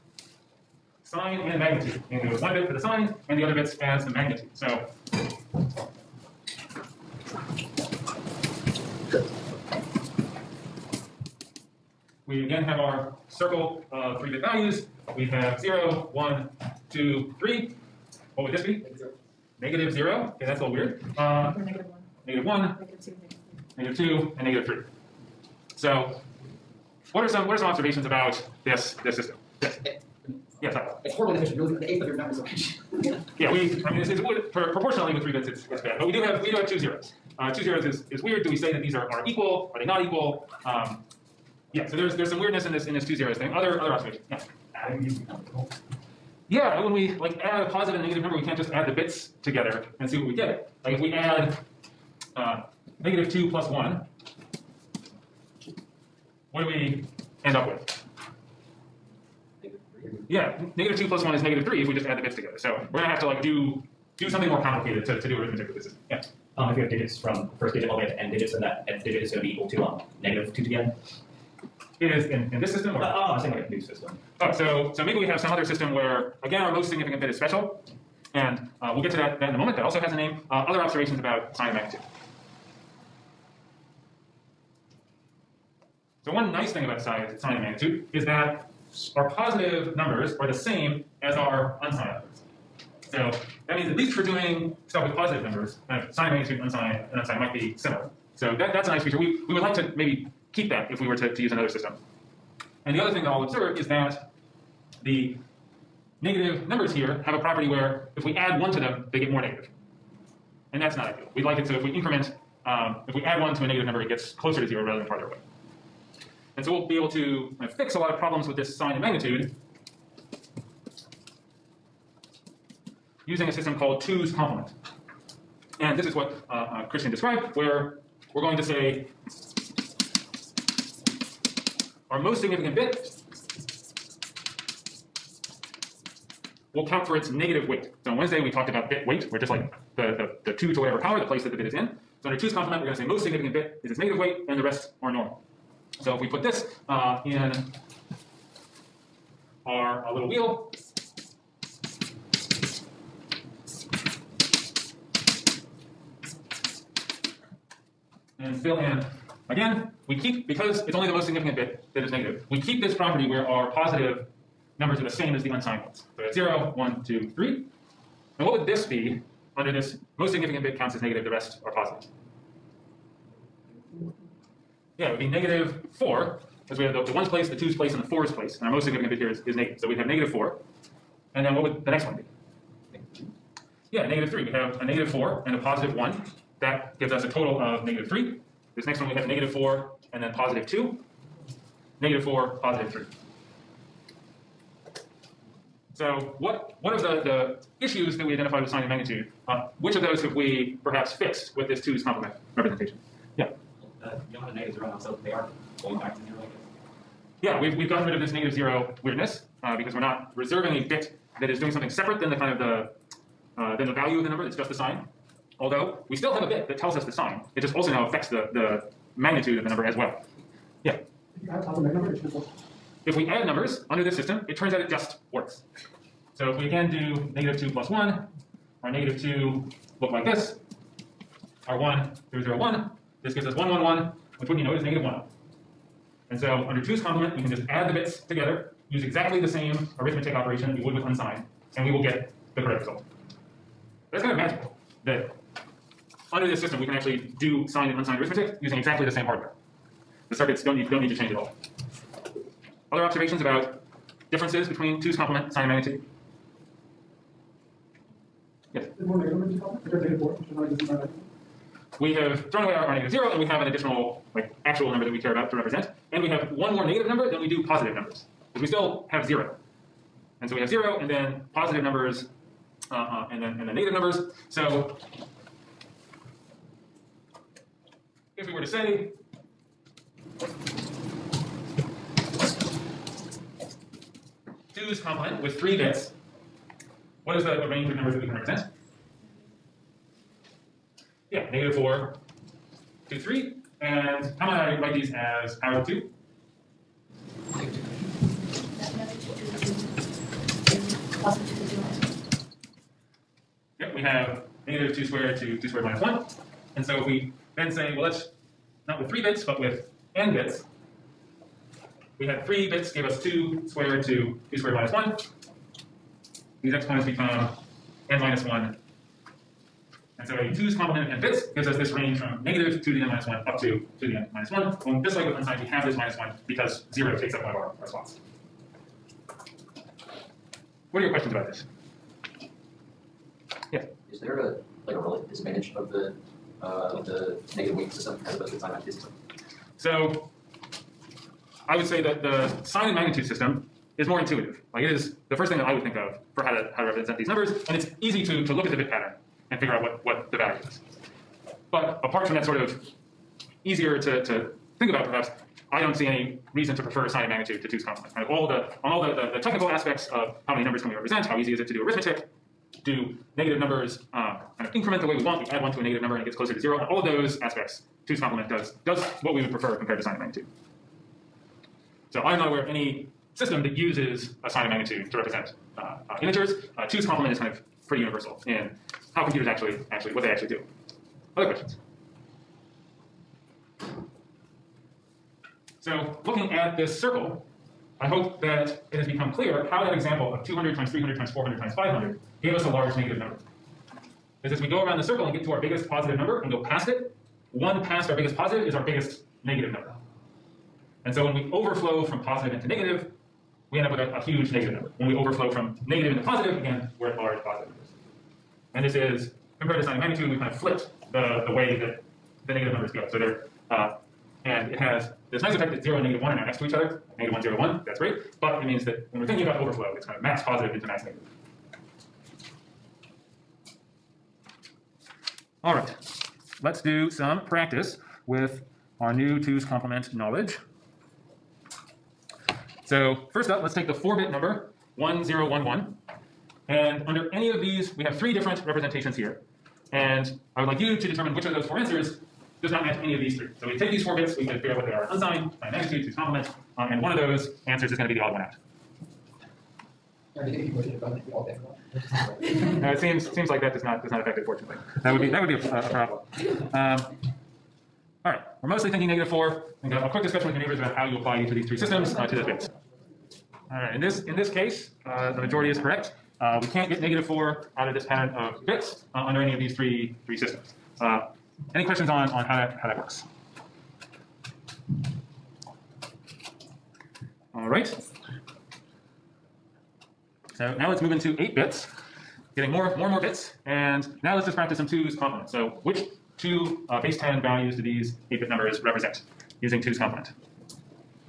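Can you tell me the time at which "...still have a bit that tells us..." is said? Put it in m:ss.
3:36.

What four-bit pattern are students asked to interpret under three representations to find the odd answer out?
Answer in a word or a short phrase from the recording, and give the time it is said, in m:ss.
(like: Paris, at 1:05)
1011, at 7:14.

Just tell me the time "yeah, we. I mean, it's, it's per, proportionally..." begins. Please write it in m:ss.
0:33.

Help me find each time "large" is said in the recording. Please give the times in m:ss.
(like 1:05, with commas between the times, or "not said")
6:32, 6:47.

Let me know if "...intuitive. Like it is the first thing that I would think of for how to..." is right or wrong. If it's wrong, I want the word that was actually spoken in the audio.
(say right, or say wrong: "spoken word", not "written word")
right.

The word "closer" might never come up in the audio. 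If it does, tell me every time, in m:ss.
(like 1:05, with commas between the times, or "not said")
1:54, 6:06.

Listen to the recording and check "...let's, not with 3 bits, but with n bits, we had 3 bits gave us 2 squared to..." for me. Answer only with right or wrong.
right.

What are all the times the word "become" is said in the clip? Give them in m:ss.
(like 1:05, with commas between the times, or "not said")
5:17, 6:29.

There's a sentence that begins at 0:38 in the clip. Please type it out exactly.
Do we say that these are are equal?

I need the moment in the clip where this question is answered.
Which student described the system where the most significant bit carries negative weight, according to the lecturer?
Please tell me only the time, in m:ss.
2:06.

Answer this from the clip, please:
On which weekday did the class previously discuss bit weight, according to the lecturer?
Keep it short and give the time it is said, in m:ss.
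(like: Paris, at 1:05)
Wednesday, at 2:18.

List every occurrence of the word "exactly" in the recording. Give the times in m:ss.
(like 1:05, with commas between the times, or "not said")
3:59, 4:08.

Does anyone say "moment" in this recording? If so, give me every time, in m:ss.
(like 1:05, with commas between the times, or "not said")
1:19.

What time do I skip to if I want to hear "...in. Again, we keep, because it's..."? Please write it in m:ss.
2:38.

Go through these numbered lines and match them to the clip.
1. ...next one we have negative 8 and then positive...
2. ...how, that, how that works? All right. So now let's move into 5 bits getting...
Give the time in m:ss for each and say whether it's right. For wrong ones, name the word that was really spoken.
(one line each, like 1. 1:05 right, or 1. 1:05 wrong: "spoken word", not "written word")
1. 3:08 wrong: "4", not "8"
2. 7:52 wrong: "8", not "5".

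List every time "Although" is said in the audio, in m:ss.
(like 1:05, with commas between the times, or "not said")
3:35.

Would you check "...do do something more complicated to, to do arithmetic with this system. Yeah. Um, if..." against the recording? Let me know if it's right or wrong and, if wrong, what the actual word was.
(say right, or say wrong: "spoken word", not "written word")
right.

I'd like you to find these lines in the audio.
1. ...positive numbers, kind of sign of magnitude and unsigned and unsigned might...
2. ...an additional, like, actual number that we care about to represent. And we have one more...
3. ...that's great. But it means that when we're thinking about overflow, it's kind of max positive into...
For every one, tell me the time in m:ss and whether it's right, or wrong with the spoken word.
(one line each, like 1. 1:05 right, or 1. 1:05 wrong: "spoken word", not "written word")
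1. 1:35 right
2. 4:23 right
3. 6:57 right.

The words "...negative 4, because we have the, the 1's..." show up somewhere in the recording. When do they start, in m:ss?
2:55.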